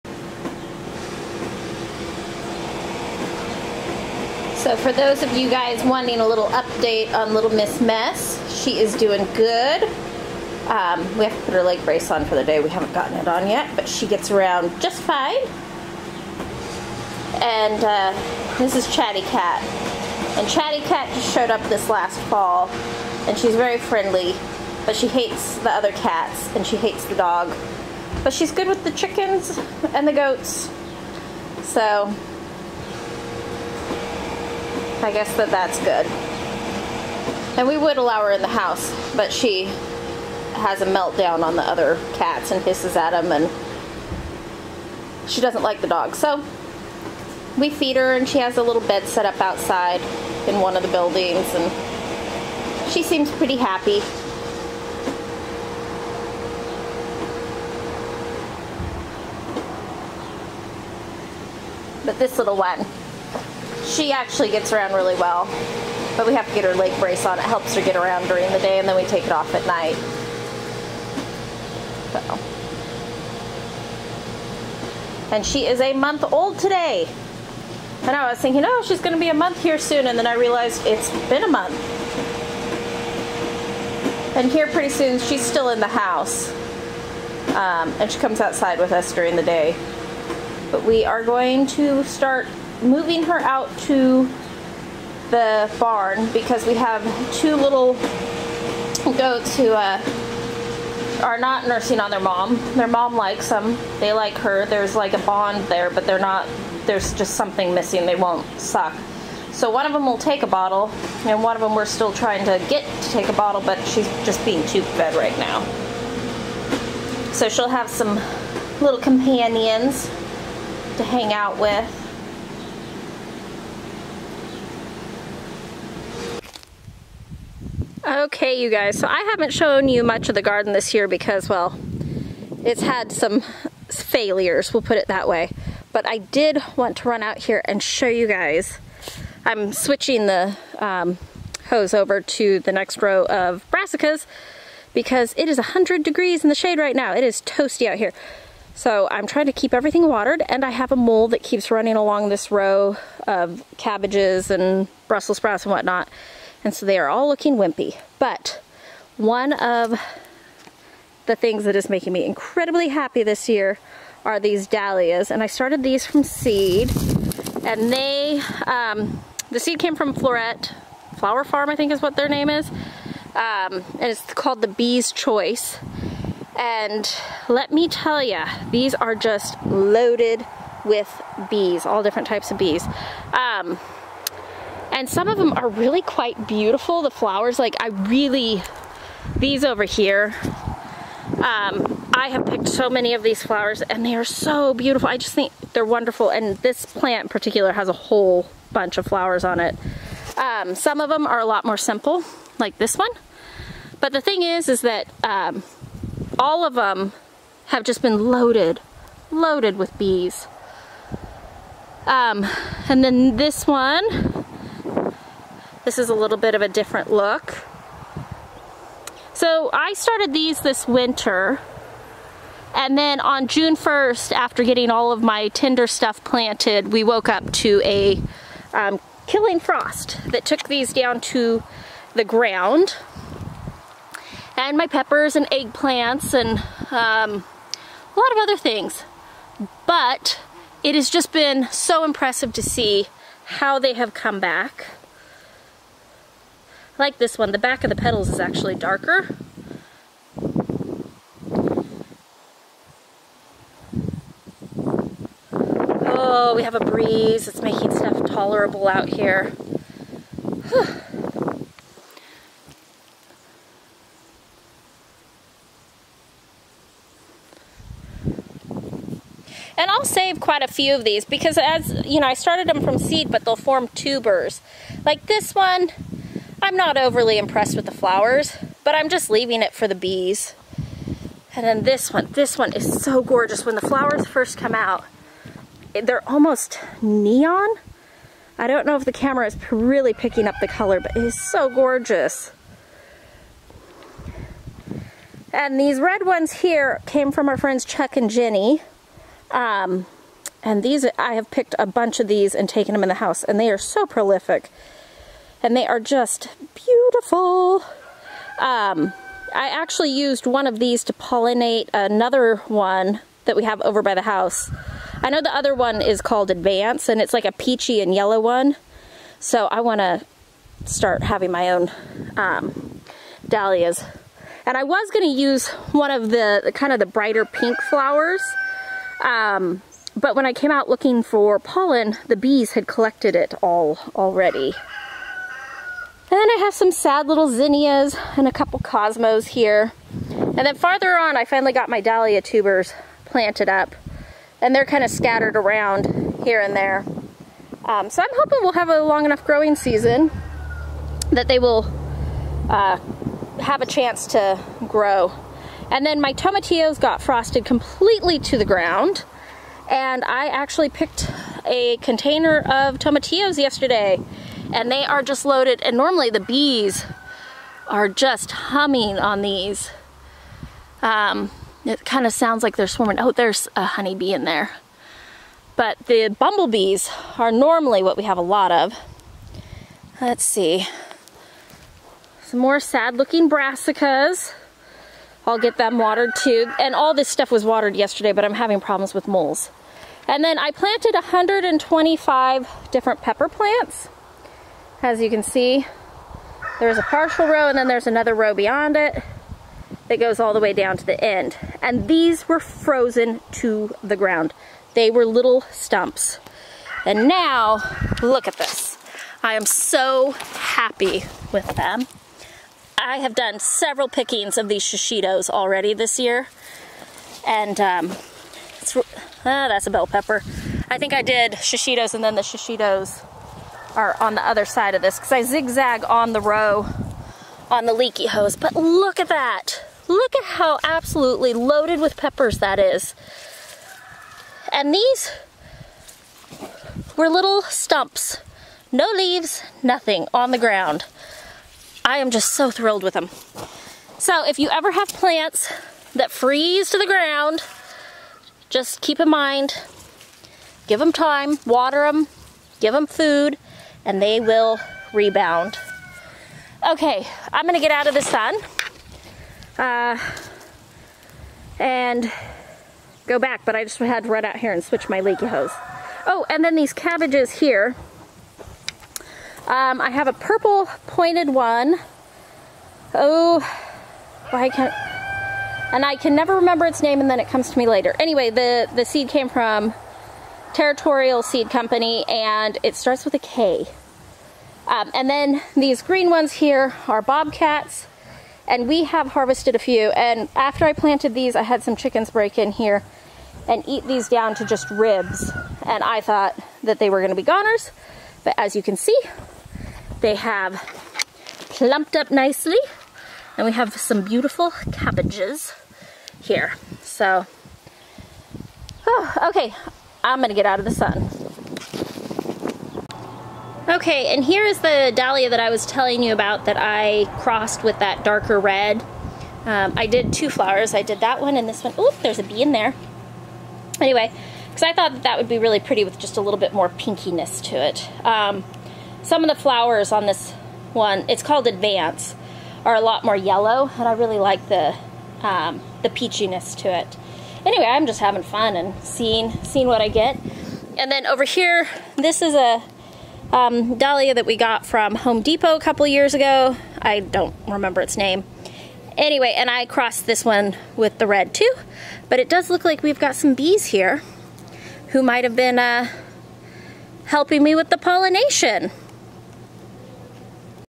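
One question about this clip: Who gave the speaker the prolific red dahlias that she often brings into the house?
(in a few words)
Chuck and Jenny.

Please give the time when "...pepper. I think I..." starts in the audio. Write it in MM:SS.
07:00.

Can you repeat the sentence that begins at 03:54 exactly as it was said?
And my peppers and eggplants and um, a lot of other things.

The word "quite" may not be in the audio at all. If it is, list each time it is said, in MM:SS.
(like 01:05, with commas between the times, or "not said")
03:06, 04:30.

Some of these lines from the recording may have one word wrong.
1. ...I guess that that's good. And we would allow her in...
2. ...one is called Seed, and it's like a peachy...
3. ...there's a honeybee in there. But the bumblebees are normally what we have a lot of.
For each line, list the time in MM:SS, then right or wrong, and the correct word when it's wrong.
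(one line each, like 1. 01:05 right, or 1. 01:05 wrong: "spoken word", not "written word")
1. 00:35 right
2. 05:15 wrong: "Advance", not "Seed"
3. 06:13 right.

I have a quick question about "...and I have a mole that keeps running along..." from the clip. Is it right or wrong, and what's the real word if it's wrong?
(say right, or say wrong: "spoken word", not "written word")
right.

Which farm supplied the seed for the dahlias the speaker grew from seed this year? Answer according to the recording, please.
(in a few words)
Floret Flower Farm.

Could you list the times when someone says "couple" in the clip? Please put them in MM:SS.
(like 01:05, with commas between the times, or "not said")
05:38, 09:05.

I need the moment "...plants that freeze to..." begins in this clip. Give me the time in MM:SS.
07:25.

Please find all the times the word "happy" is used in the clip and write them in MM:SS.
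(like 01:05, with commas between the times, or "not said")
00:53, 02:42, 06:50.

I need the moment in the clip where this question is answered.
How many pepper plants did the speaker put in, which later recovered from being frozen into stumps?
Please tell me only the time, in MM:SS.
06:31.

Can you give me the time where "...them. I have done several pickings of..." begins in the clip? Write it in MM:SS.
06:51.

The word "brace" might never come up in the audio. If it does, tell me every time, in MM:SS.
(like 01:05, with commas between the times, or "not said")
00:11, 01:06.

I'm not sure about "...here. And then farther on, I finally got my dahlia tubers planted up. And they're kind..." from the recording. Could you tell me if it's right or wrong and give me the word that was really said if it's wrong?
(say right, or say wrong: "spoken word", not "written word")
right.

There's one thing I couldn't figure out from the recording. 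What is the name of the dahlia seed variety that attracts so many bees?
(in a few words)
Bee's Choice.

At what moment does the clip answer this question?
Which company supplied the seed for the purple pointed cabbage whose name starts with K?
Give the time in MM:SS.
08:00.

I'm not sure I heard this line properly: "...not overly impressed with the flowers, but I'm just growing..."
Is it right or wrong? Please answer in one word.
wrong.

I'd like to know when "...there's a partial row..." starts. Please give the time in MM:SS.
06:36.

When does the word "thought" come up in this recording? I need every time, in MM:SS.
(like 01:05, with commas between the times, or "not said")
08:16, 08:44.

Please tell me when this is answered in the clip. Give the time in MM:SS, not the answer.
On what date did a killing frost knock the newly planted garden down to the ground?
03:43.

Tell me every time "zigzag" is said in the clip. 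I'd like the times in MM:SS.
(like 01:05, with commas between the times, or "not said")
07:05.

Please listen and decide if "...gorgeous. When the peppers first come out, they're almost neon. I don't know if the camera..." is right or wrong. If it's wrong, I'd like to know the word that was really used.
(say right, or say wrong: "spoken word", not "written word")
wrong: "flowers", not "peppers".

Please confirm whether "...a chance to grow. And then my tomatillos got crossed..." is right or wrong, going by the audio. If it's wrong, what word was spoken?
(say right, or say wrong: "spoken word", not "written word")
wrong: "frosted", not "crossed".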